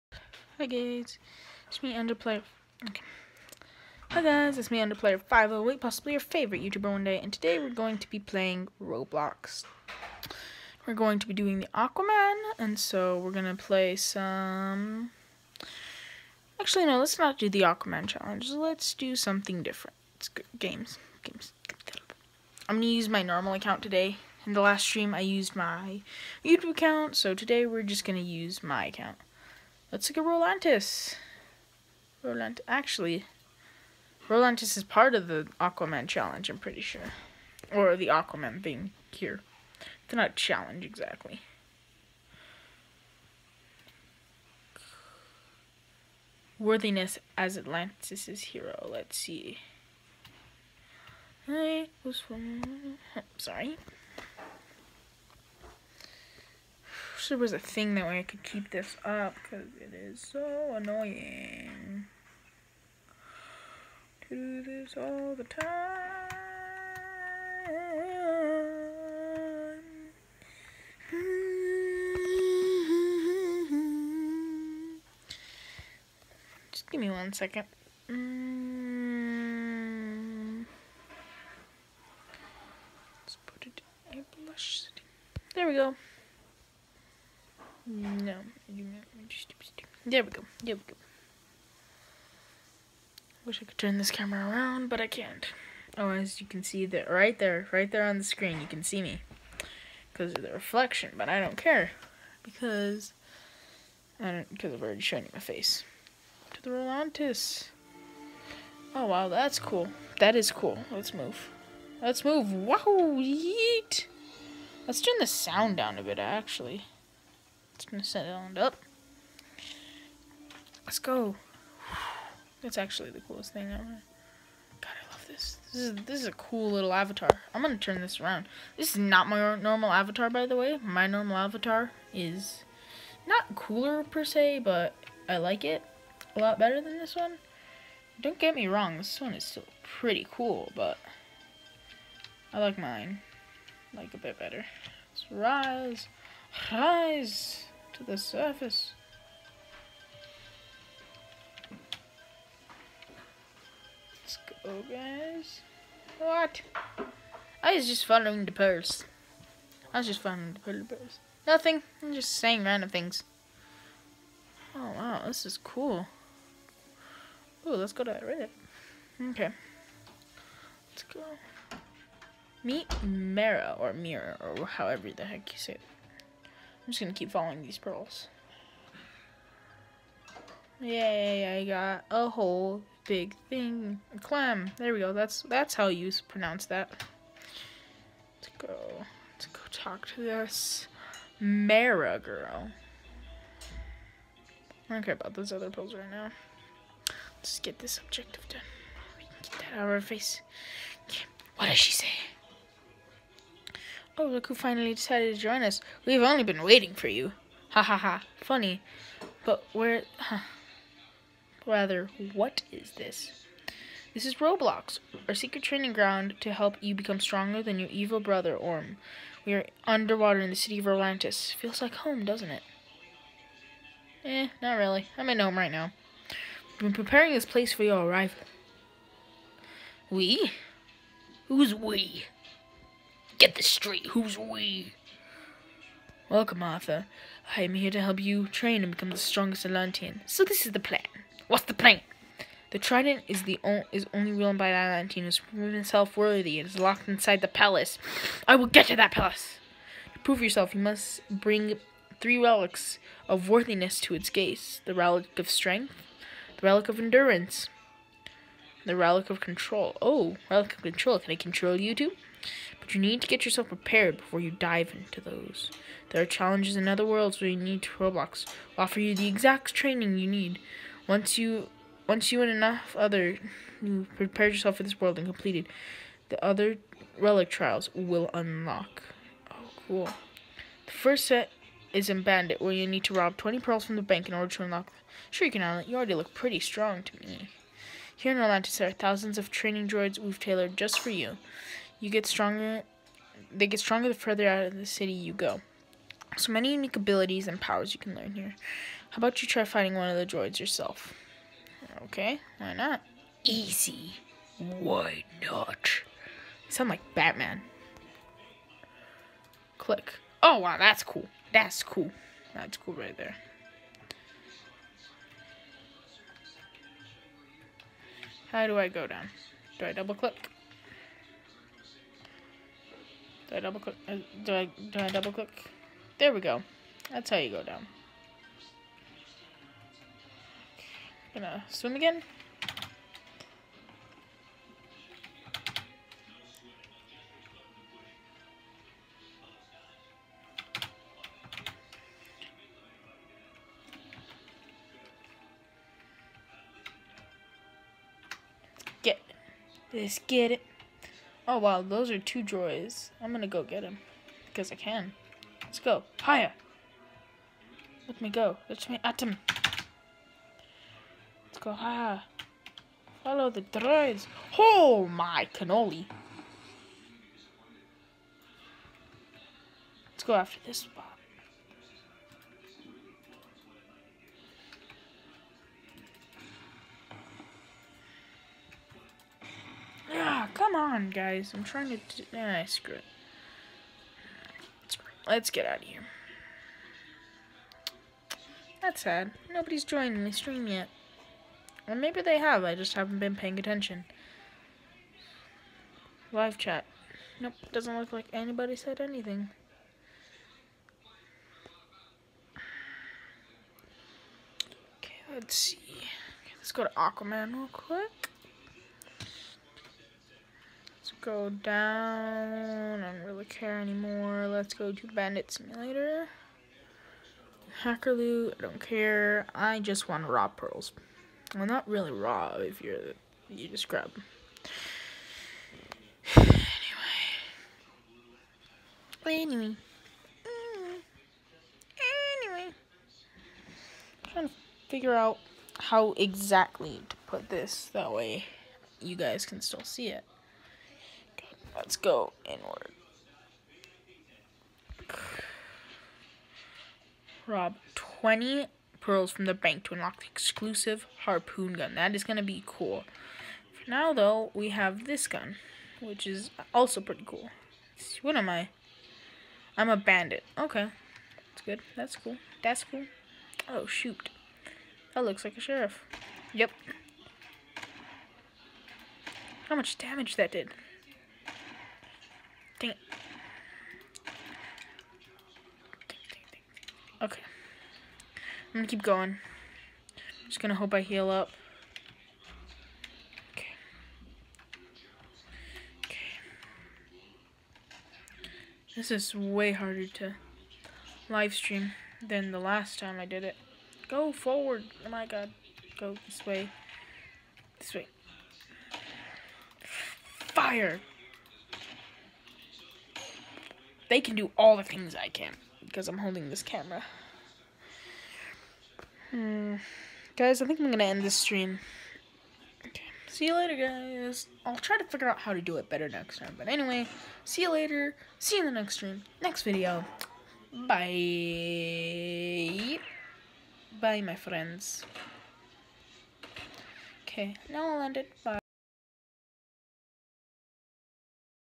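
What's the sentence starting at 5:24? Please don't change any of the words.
Uh, do I do I double click?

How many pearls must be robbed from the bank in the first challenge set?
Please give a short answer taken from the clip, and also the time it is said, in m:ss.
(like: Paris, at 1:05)
20, at 4:43.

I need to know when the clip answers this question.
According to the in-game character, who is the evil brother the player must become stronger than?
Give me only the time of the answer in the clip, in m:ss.
3:38.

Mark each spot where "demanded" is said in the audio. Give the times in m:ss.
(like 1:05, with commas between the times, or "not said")
not said.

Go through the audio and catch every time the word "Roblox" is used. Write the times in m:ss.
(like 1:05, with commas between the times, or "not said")
0:08, 3:34, 4:27.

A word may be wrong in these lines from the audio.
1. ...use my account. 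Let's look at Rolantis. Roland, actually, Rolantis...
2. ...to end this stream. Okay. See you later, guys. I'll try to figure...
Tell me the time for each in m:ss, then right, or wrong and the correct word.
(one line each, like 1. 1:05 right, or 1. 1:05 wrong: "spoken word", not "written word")
1. 0:28 right
2. 8:30 right.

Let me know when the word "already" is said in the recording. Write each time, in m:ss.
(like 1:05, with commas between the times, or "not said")
1:44, 4:45.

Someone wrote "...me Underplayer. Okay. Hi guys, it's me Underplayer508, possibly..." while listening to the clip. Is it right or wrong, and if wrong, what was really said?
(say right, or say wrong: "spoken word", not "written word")
right.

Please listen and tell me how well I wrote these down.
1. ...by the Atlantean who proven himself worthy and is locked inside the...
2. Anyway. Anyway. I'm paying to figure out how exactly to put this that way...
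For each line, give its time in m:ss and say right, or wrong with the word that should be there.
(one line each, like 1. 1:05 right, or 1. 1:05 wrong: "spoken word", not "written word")
1. 4:04 right
2. 7:09 wrong: "trying", not "paying".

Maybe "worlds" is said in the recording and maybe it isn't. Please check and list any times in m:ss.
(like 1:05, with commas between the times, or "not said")
4:27, 4:34.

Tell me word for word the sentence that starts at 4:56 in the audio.
So many unique abilities and powers you can learn here.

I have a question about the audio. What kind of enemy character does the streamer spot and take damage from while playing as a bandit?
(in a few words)
A sheriff.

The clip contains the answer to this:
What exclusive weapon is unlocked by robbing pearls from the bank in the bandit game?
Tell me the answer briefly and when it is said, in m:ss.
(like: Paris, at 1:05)
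Harpoon gun, at 7:31.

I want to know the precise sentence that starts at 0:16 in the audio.
Actually, no, let's not do the Aquaman challenge.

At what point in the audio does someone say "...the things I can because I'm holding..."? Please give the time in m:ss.
8:24.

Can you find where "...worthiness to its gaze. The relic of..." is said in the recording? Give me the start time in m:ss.
4:13.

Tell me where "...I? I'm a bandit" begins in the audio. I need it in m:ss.
7:38.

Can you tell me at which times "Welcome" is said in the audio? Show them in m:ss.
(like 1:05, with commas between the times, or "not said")
3:56.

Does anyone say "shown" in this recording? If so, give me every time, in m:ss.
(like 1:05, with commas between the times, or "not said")
1:45.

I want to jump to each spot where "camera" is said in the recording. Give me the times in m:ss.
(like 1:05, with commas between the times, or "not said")
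1:34, 8:26.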